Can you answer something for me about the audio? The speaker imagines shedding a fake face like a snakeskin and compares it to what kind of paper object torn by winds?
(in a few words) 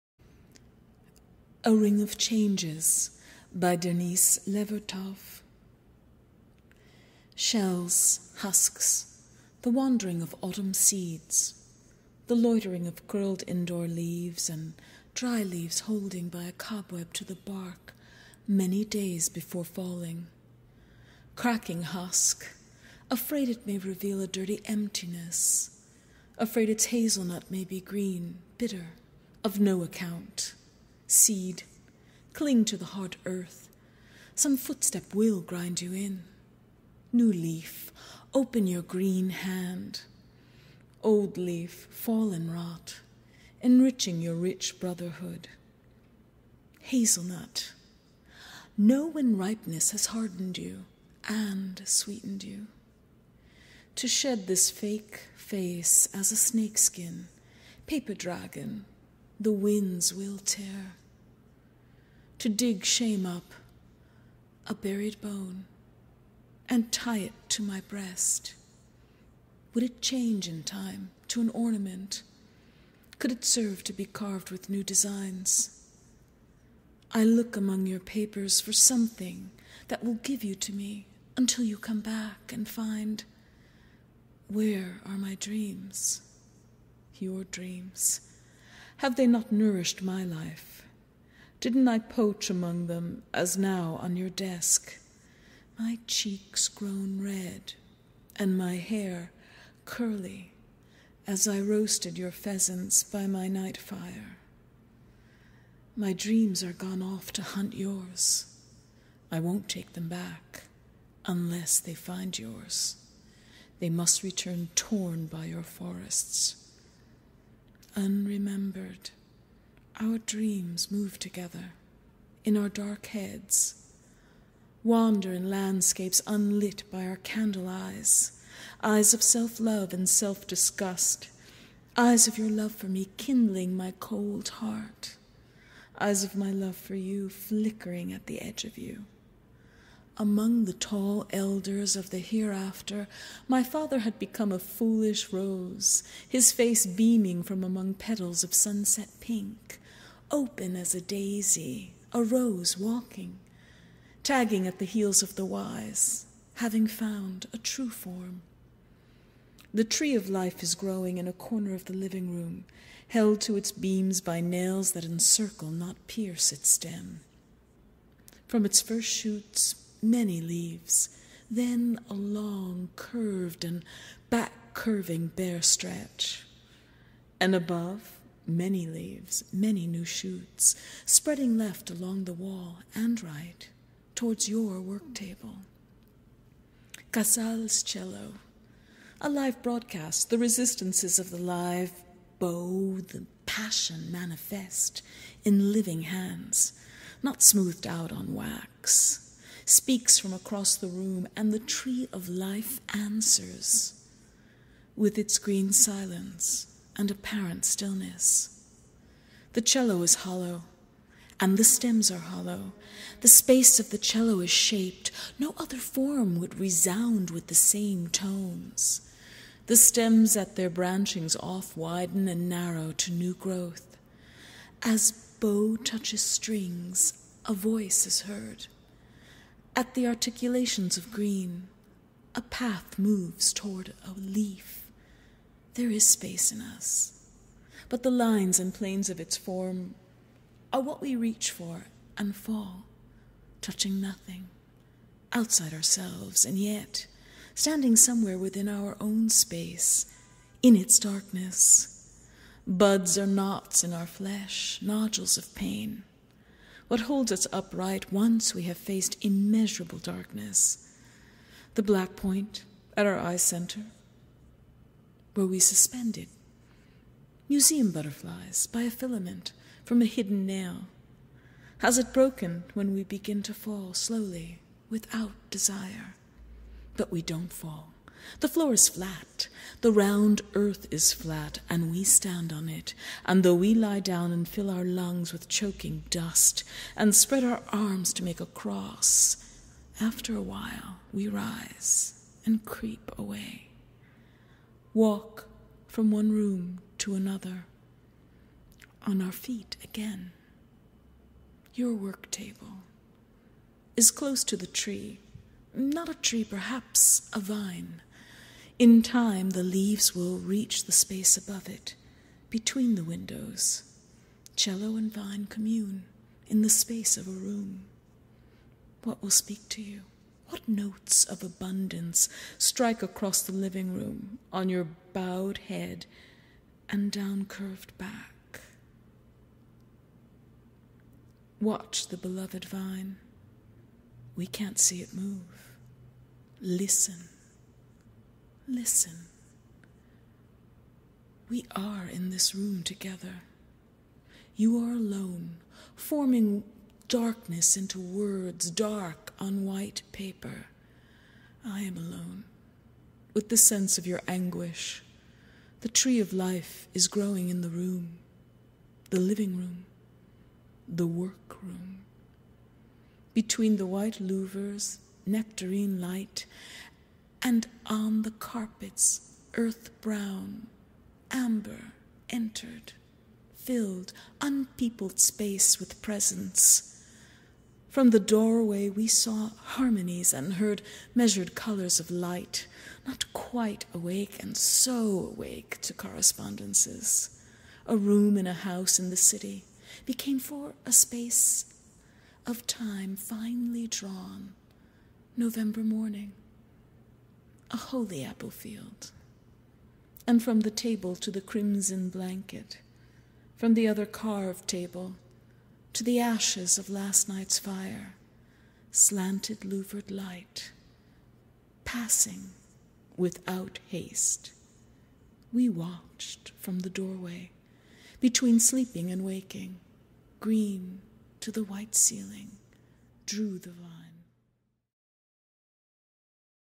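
Paper dragon.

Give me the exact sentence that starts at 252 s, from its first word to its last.
Buds are knots in our flesh, nodules of pain what holds us upright once we have faced immeasurable darkness.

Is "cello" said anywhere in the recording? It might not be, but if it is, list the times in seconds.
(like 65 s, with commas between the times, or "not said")
187 s, 209 s, 213 s, 314 s.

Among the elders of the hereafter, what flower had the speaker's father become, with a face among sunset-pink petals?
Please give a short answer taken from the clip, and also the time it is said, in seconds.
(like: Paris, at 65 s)
A rose, at 144 s.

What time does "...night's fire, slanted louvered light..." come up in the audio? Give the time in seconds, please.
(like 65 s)
407 s.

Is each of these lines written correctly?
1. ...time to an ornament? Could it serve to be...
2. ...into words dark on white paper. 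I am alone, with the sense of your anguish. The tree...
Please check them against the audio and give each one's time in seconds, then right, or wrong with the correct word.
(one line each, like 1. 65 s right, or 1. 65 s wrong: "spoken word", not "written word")
1. 70 s right
2. 347 s right.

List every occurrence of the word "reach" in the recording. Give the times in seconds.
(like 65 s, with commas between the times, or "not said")
241 s, 310 s.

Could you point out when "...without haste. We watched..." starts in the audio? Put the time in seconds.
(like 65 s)
413 s.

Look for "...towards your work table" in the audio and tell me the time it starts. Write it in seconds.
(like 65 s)
184 s.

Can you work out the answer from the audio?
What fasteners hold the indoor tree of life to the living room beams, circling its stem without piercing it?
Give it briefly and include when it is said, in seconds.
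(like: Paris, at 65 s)
Nails, at 164 s.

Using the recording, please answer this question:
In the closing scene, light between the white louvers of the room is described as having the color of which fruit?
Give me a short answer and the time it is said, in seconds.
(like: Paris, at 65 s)
Nectarine, at 365 s.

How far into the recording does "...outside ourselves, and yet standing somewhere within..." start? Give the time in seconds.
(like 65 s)
245 s.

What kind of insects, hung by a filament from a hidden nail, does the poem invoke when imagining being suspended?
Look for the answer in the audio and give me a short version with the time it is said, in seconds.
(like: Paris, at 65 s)
Museum butterflies, at 267 s.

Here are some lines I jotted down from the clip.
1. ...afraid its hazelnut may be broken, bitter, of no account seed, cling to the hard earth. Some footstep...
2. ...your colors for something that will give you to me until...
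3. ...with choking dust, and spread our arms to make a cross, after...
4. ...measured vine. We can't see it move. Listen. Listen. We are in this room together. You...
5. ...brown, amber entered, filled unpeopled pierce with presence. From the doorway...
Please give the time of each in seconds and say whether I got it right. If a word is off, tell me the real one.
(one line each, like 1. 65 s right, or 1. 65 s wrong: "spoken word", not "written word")
1. 26 s wrong: "green", not "broken"
2. 77 s wrong: "papers", not "colors"
3. 285 s right
4. 332 s wrong: "beloved", not "measured"
5. 370 s wrong: "space", not "pierce".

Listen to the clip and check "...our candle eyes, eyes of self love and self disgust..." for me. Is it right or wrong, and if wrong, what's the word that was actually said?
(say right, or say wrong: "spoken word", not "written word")
right.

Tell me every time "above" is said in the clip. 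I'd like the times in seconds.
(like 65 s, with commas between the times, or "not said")
177 s, 311 s.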